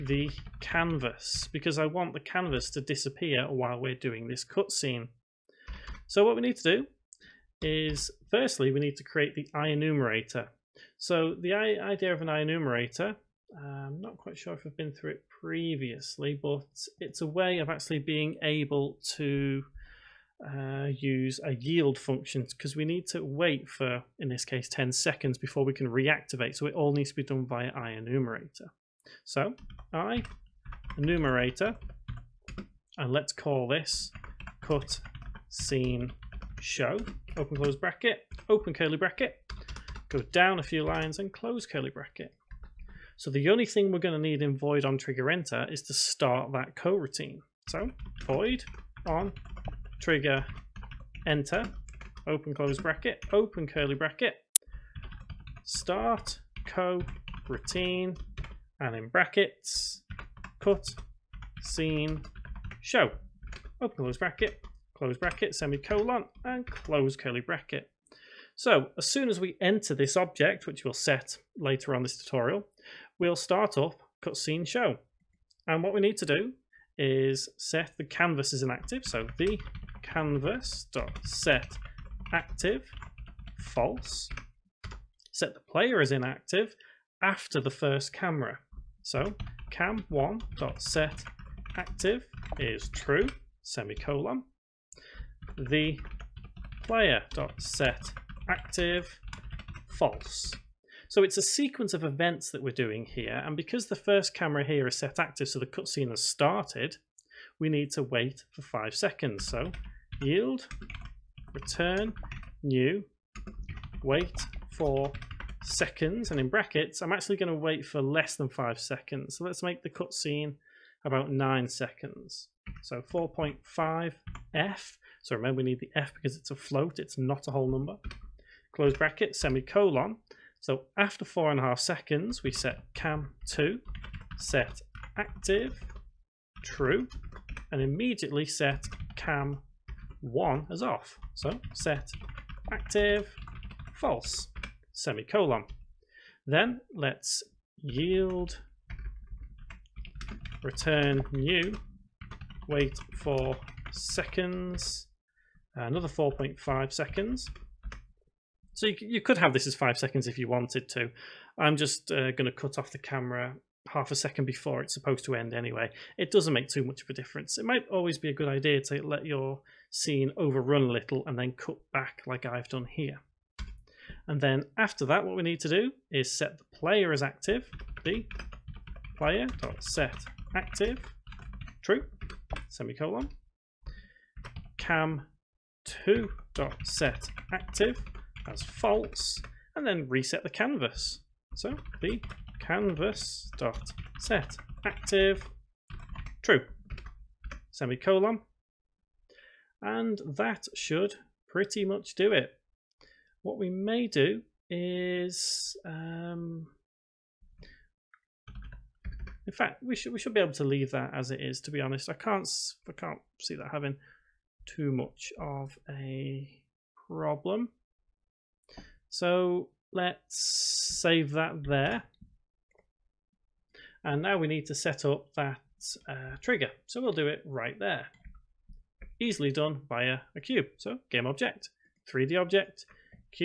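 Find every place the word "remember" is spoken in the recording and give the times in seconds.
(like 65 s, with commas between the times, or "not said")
125 s.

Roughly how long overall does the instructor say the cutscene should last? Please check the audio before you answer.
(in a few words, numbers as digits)
about 9 seconds.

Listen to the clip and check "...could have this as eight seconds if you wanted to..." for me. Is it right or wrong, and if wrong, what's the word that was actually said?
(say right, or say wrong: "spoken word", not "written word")
wrong: "five", not "eight".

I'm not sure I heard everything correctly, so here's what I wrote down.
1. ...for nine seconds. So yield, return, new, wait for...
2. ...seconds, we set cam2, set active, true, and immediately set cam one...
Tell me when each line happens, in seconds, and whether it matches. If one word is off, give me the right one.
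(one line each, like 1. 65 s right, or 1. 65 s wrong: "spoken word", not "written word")
1. 108 s wrong: "five", not "nine"
2. 131 s right.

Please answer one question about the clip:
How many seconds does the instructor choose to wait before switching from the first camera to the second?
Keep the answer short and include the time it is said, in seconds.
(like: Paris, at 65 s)
4.5, at 123 s.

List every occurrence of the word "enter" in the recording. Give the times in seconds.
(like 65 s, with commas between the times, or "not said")
45 s, 51 s, 69 s.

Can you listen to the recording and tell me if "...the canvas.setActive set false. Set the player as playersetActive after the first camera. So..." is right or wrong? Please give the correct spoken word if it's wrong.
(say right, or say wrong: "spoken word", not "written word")
wrong: "inactive", not "playersetActive".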